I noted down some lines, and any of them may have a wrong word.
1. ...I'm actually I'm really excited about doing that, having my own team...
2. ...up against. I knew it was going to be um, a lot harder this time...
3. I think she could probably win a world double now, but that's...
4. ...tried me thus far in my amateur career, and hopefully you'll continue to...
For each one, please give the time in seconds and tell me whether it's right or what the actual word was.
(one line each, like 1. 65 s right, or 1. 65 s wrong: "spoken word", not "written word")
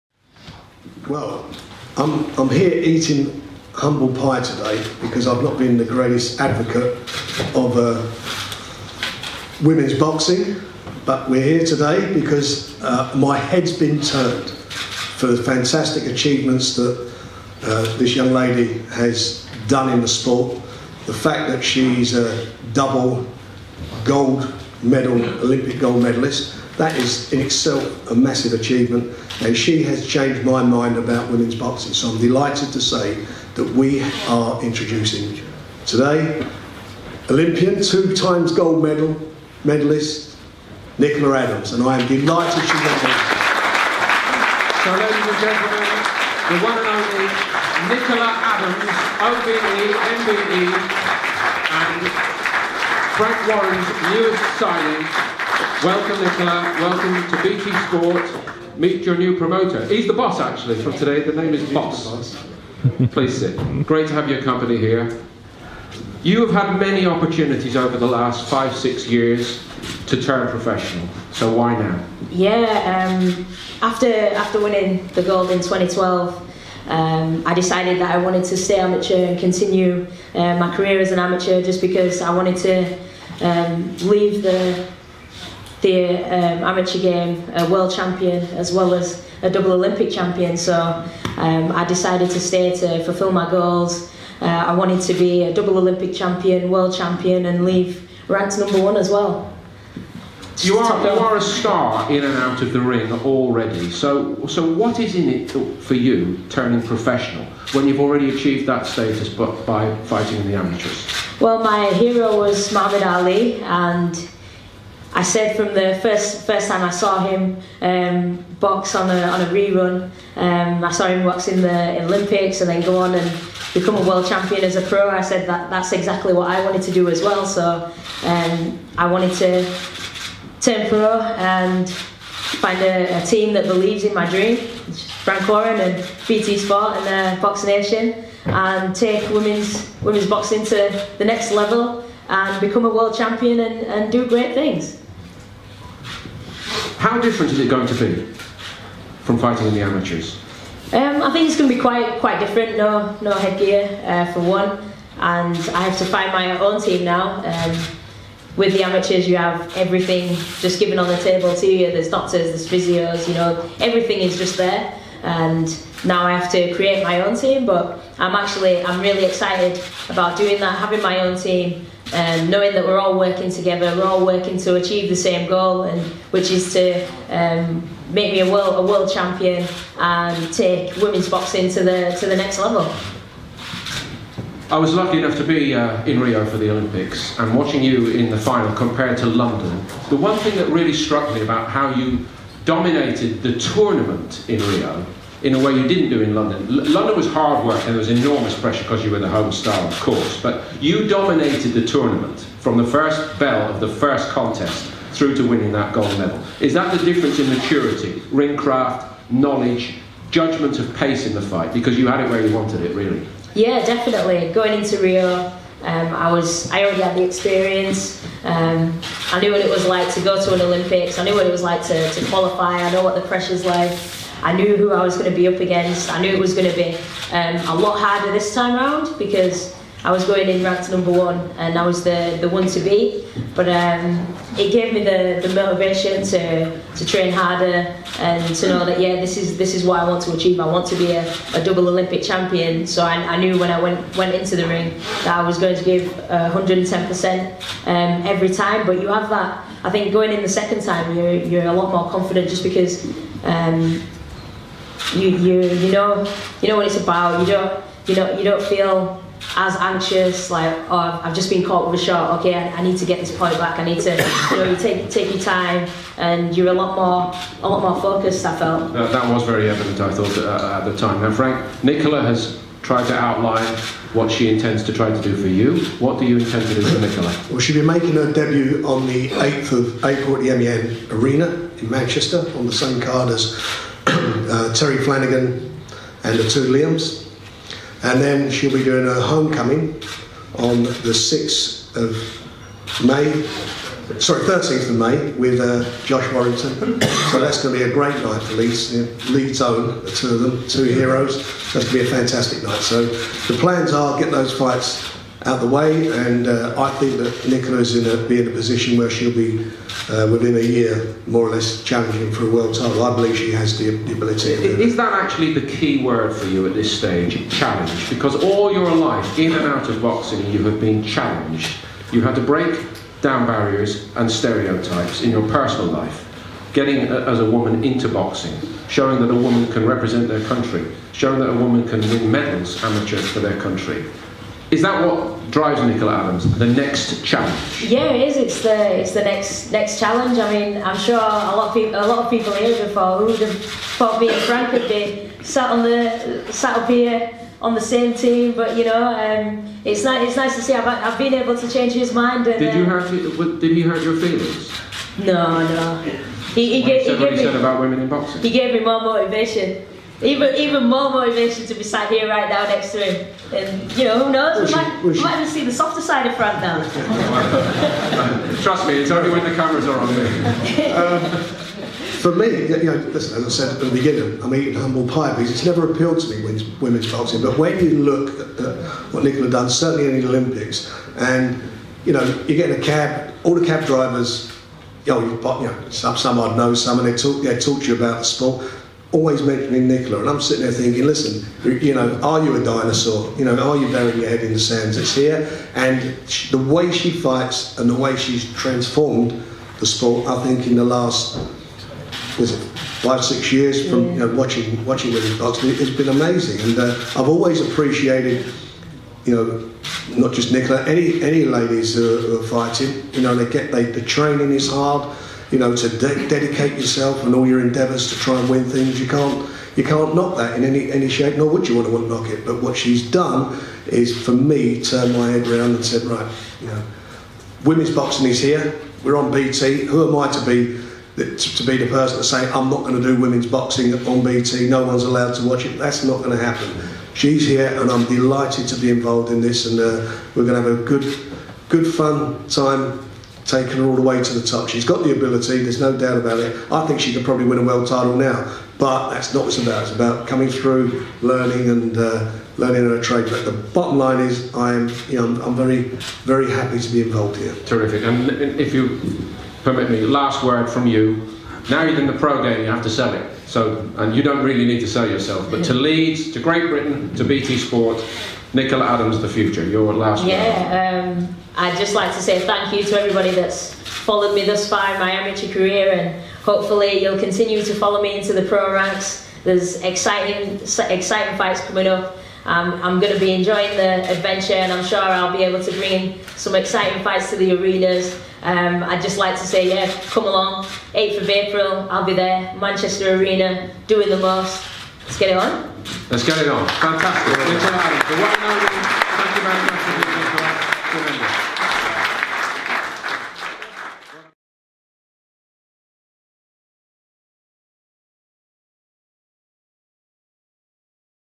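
1. 168 s right
2. 225 s right
3. 446 s wrong: "title", not "double"
4. 473 s wrong: "followed", not "tried".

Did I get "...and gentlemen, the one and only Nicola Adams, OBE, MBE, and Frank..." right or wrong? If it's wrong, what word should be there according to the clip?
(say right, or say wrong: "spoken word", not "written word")
right.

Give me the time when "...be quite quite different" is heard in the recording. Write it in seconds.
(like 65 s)
151 s.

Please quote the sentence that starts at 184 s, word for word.
I was lucky enough to be uh, in Rio for the Olympics and watching you in the final compared to London.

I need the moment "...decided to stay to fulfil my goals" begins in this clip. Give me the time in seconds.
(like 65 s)
91 s.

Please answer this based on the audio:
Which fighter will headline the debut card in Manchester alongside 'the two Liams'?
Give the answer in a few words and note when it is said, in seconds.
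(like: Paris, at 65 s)
Terry Flanagan, at 284 s.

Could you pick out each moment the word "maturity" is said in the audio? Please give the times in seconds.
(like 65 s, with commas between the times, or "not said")
207 s.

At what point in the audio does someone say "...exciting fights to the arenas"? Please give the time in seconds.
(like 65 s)
486 s.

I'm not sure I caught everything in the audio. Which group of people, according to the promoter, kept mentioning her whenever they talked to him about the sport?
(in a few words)
cab drivers.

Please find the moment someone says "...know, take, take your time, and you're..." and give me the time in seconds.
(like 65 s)
264 s.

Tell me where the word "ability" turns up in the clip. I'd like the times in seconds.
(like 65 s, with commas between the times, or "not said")
314 s, 445 s.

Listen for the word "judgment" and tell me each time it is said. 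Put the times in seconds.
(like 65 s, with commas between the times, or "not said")
210 s.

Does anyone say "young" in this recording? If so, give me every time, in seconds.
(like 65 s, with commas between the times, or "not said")
18 s.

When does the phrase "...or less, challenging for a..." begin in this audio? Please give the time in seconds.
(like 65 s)
311 s.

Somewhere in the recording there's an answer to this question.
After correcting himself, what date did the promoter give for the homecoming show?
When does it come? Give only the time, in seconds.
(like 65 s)
294 s.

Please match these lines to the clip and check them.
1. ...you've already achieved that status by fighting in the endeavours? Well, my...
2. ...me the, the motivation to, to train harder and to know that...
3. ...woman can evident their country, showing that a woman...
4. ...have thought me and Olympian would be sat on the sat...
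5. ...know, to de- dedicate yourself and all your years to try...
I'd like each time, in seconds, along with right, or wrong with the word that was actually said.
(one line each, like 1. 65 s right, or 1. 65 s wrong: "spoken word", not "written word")
1. 107 s wrong: "amateurs", not "endeavours"
2. 234 s right
3. 329 s wrong: "represent", not "evident"
4. 343 s wrong: "Frank", not "Olympian"
5. 415 s wrong: "endeavours", not "years".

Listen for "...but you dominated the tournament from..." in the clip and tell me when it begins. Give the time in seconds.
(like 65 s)
200 s.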